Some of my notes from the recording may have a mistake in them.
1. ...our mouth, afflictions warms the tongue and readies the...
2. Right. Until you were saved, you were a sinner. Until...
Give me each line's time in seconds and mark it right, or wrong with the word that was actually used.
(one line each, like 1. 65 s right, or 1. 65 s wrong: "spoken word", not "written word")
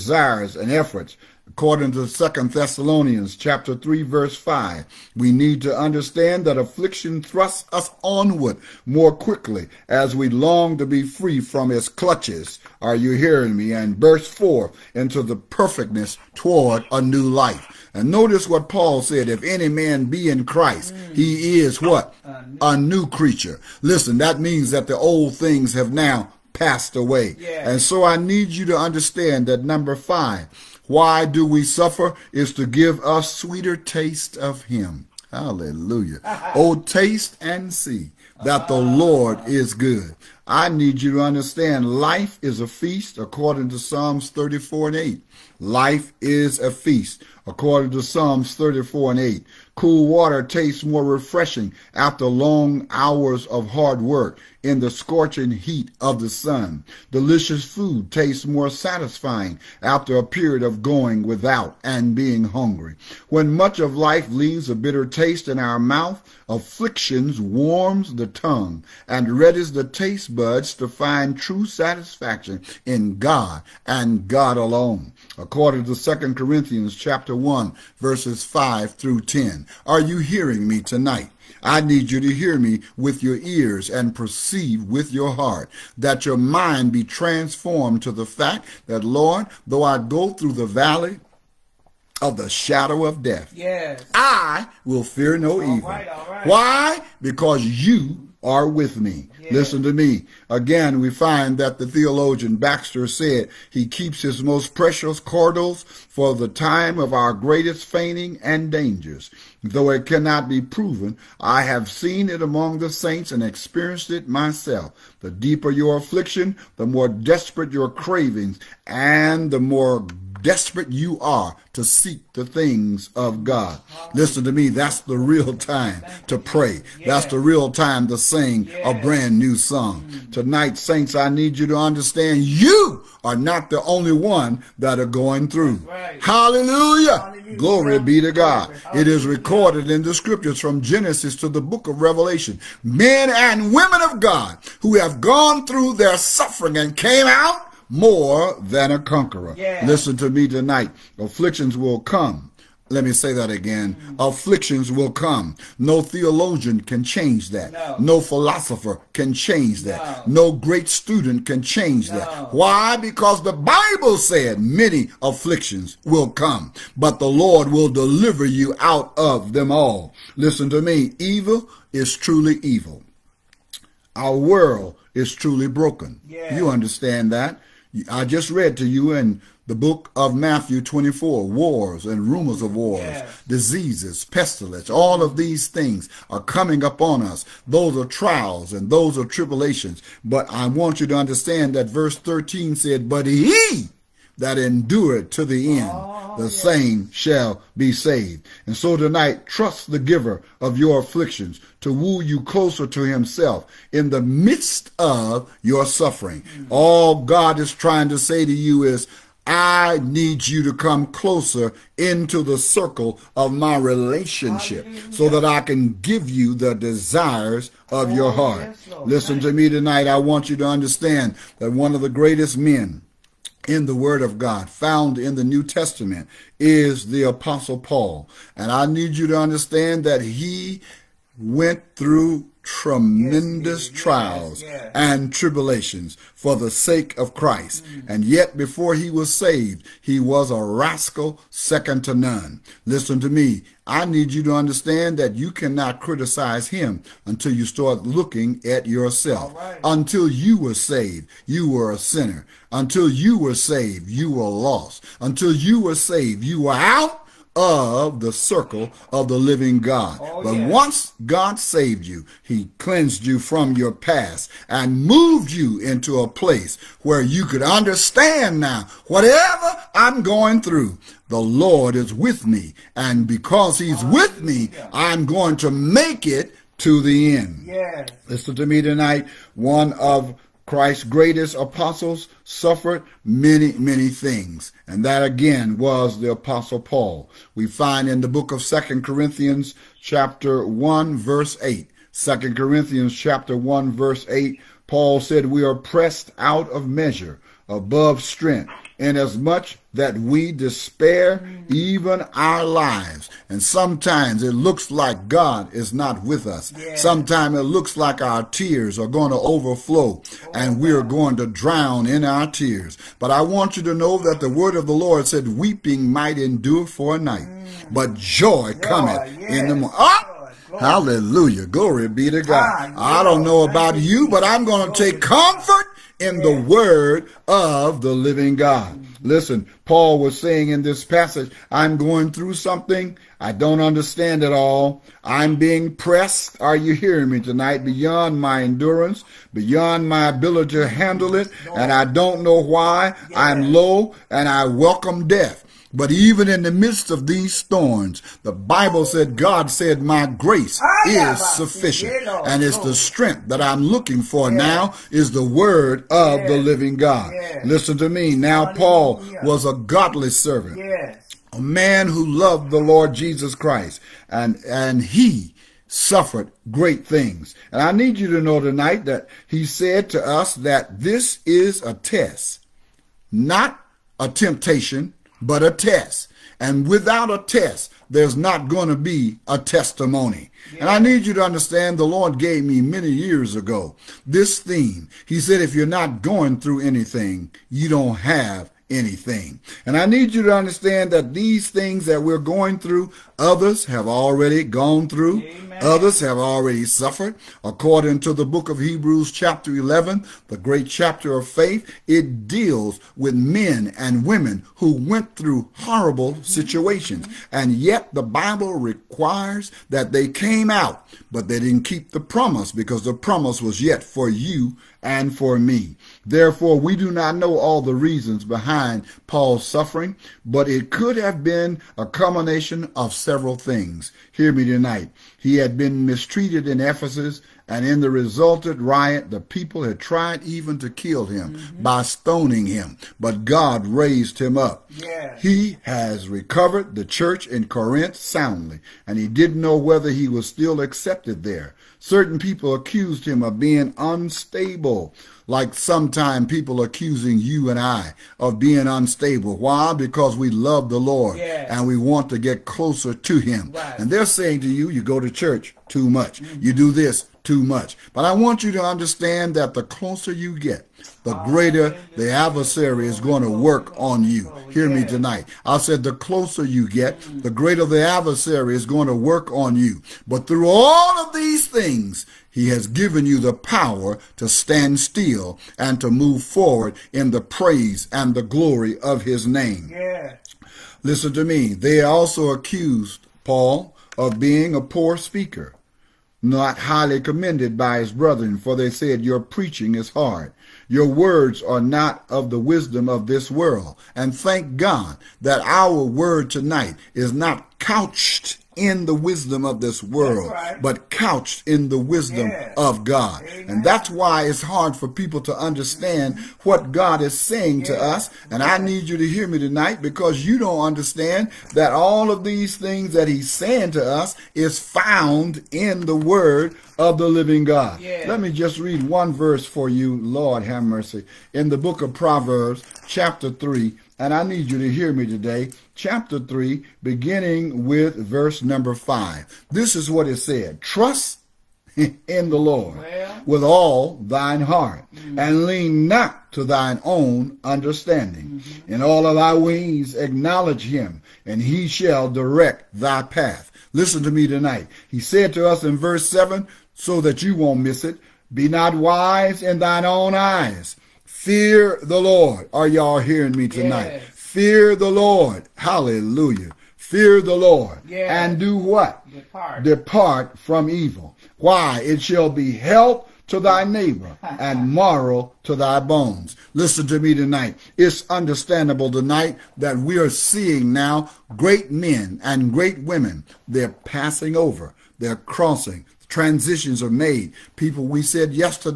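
1. 65 s right
2. 249 s right.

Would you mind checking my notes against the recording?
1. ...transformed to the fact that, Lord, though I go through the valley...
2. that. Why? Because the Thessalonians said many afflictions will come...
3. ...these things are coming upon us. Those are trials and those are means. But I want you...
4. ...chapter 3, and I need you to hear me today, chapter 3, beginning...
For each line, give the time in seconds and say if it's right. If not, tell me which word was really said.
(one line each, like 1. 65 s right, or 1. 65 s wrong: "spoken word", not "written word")
1. 87 s right
2. 162 s wrong: "Bible", not "Thessalonians"
3. 185 s wrong: "tribulations", not "means"
4. 523 s right.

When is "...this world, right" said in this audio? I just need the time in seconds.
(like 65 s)
499 s.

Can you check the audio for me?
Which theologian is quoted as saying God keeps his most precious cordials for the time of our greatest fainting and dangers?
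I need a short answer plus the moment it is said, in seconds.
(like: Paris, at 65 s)
Baxter, at 102 s.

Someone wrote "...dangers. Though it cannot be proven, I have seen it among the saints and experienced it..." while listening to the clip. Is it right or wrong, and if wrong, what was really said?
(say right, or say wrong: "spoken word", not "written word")
right.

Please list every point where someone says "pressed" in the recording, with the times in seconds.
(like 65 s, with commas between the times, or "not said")
295 s, 335 s.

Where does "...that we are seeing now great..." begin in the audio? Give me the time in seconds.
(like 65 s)
569 s.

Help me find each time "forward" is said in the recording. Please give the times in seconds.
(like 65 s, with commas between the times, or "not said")
476 s.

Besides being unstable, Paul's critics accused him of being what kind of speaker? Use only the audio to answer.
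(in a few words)
a poor speaker.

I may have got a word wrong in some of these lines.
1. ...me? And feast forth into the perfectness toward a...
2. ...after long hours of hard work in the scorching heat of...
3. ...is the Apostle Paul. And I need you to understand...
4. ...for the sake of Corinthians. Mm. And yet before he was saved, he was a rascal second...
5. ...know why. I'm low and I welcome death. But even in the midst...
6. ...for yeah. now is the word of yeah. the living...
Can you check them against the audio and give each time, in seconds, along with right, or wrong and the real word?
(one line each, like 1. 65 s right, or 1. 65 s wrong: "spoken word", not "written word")
1. 13 s wrong: "burst", not "feast"
2. 51 s right
3. 226 s right
4. 236 s wrong: "Christ", not "Corinthians"
5. 342 s right
6. 354 s right.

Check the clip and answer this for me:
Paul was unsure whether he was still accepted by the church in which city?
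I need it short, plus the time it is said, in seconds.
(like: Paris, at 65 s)
Corinth, at 437 s.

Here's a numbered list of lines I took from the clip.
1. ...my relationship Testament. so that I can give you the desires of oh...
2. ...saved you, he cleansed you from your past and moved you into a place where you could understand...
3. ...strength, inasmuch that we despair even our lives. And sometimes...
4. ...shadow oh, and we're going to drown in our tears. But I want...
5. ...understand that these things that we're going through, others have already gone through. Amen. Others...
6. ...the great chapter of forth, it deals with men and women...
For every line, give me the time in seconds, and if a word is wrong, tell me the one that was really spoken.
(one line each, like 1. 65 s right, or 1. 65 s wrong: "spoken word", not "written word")
1. 213 s wrong: "Hallelujah", not "Testament"
2. 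261 s right
3. 298 s right
4. 309 s wrong: "overflow", not "shadow"
5. 390 s right
6. 400 s wrong: "faith", not "forth".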